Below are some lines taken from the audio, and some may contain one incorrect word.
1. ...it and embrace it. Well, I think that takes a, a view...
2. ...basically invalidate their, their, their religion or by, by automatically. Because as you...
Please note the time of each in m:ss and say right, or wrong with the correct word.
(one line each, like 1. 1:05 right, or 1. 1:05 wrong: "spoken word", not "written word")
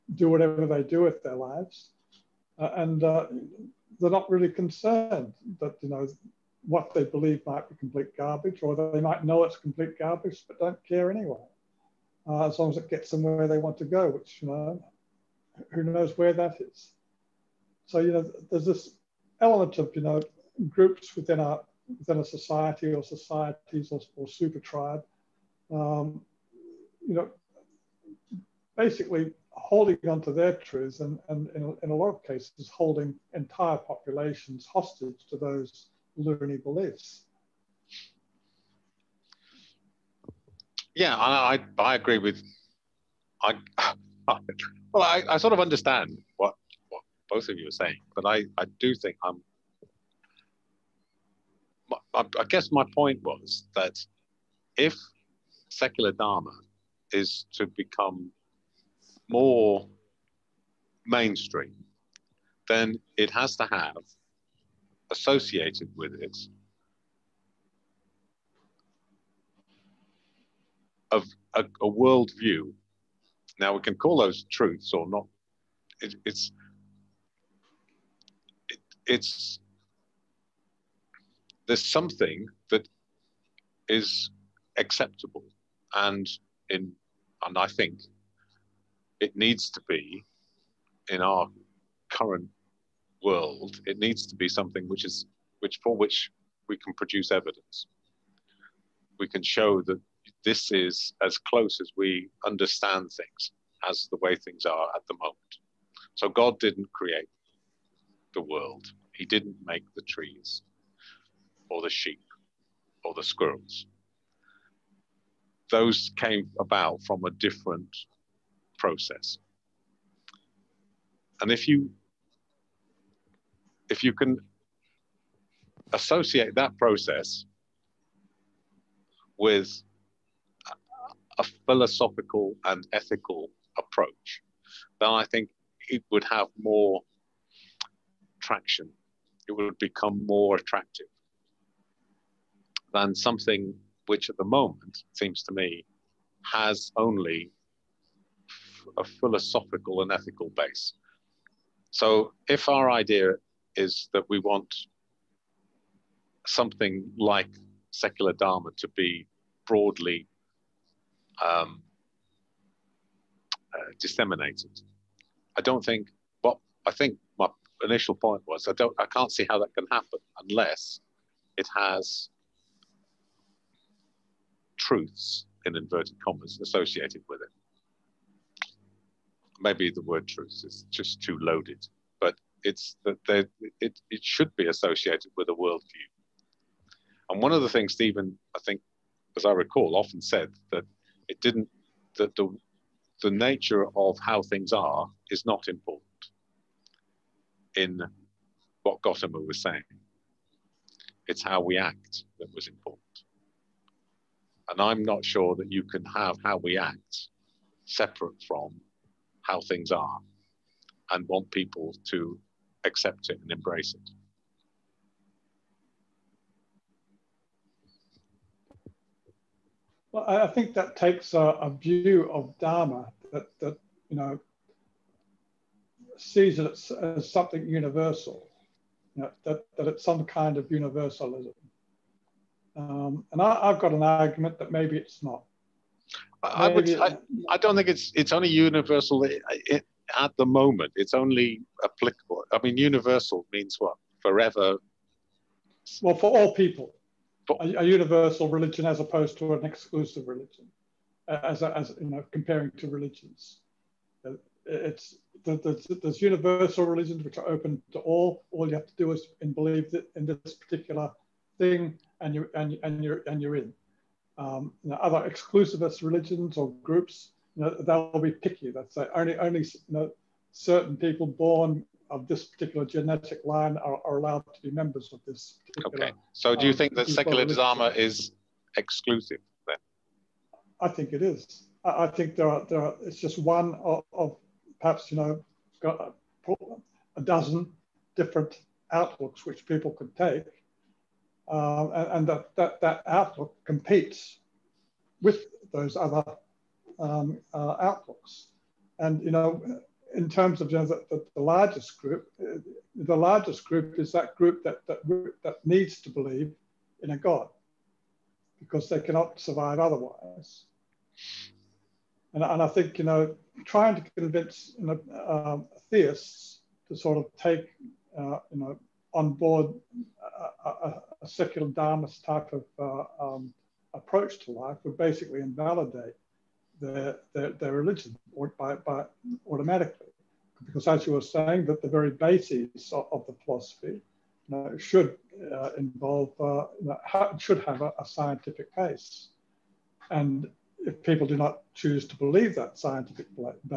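1. 3:33 right
2. 5:24 right.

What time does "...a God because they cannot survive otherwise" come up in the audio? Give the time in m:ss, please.
5:07.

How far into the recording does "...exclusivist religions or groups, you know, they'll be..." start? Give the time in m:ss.
4:25.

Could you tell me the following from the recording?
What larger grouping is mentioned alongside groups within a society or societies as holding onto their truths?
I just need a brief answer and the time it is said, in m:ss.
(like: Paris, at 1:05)
Super tribe, at 0:24.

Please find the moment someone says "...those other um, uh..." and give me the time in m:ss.
4:55.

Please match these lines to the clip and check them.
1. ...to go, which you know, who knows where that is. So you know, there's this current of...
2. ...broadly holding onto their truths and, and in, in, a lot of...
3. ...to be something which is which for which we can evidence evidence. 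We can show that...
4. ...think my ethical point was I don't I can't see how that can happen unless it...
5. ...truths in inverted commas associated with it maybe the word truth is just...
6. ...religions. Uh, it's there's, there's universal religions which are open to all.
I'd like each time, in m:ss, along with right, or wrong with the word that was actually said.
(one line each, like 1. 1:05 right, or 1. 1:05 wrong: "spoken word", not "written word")
1. 0:13 wrong: "element", not "current"
2. 0:28 wrong: "basically", not "broadly"
3. 1:34 wrong: "produce", not "evidence"
4. 2:46 wrong: "initial", not "ethical"
5. 2:54 right
6. 4:12 right.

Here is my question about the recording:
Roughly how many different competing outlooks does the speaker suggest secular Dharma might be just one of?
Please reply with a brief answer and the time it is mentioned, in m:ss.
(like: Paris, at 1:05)
A dozen, at 4:47.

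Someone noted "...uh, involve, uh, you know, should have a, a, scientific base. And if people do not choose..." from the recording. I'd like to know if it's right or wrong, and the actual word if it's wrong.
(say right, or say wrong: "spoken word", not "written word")
right.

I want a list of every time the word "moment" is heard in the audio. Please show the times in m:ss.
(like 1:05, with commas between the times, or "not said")
1:45, 2:24, 4:00.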